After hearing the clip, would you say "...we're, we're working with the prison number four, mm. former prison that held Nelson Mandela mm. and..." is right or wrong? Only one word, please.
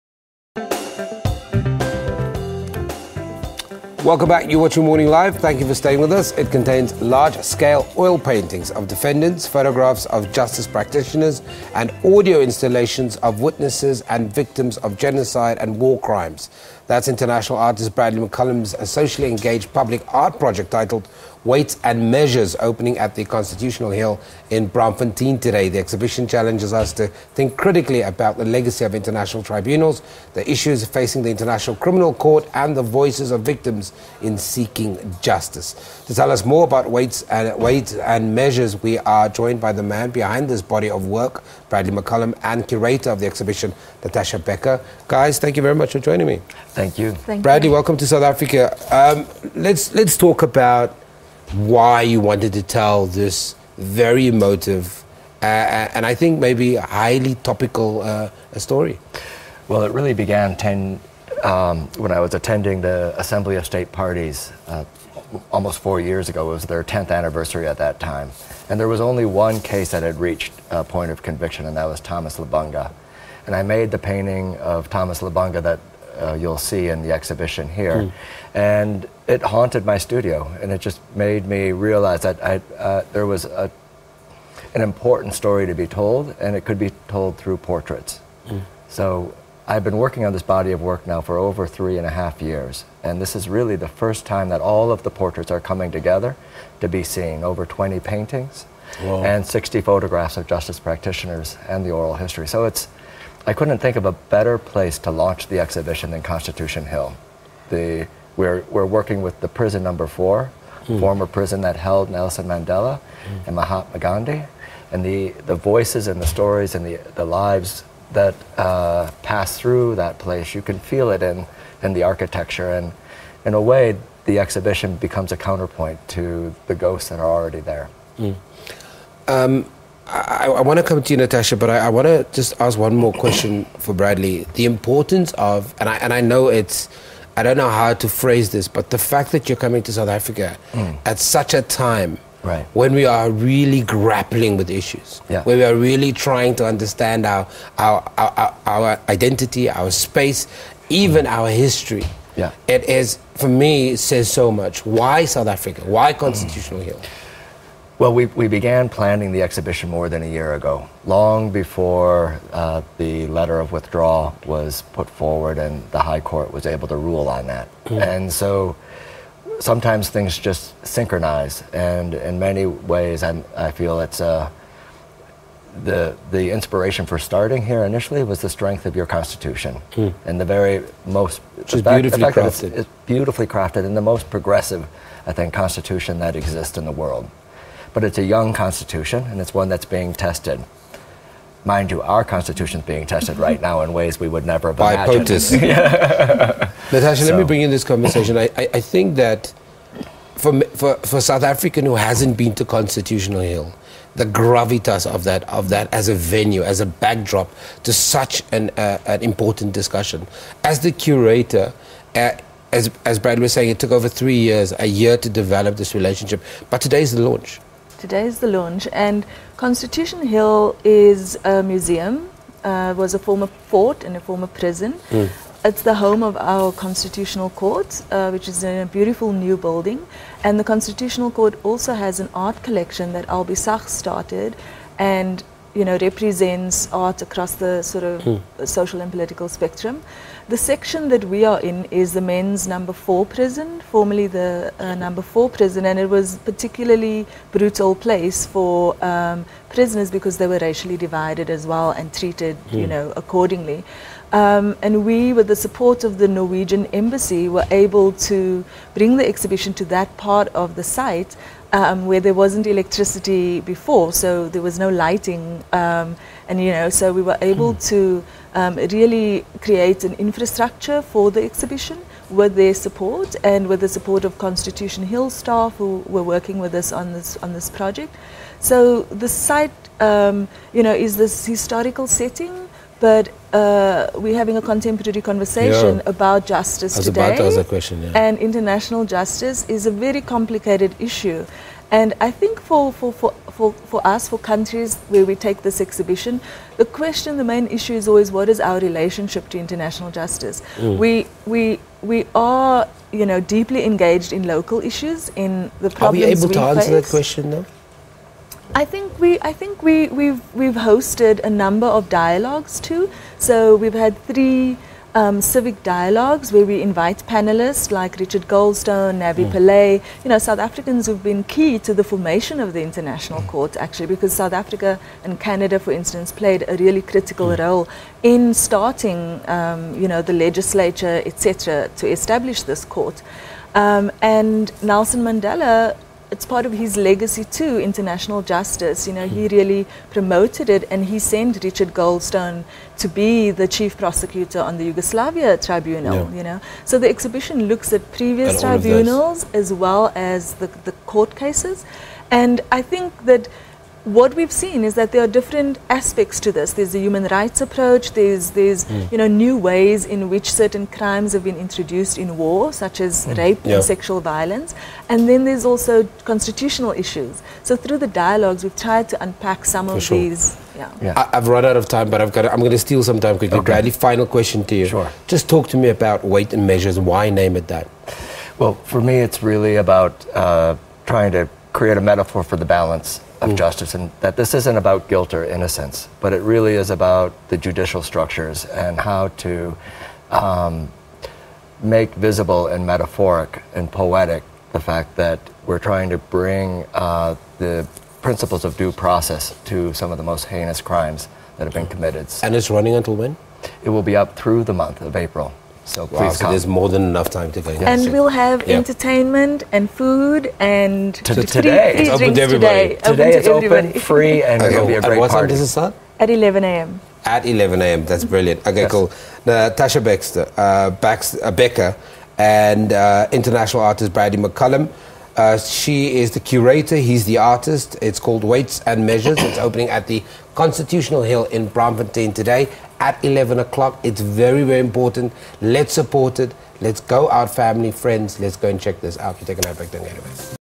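right.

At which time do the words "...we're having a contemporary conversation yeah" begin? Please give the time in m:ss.
4:44.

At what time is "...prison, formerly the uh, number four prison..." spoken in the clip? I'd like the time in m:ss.
4:03.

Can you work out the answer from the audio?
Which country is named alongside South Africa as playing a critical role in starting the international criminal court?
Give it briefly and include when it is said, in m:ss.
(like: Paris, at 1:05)
Canada, at 5:25.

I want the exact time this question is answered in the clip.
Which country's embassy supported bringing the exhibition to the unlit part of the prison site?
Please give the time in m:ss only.
4:16.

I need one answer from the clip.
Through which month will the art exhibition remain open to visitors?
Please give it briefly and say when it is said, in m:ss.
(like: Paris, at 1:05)
April, at 6:45.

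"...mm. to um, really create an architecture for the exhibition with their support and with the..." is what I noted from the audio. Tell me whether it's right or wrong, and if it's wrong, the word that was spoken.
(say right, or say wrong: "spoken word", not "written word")
wrong: "infrastructure", not "architecture".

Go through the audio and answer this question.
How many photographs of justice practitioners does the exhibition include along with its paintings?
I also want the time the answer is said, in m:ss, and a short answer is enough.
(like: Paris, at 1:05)
60, at 1:39.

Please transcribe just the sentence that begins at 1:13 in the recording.
And I made the painting of Thomas Lubanga that uh, you'll see in the exhibition here.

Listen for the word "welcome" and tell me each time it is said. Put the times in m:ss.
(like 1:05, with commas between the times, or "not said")
0:04, 0:47.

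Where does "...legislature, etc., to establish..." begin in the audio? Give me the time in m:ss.
5:30.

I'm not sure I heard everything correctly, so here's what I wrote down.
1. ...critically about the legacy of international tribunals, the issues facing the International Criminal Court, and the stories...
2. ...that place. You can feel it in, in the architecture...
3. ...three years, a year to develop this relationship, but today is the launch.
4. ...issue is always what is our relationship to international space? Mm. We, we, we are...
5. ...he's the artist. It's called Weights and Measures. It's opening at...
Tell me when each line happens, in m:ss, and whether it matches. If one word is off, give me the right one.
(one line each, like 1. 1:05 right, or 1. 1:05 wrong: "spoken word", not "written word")
1. 0:27 wrong: "voices", not "stories"
2. 1:59 right
3. 3:34 right
4. 4:57 wrong: "justice", not "space"
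5. 7:06 right.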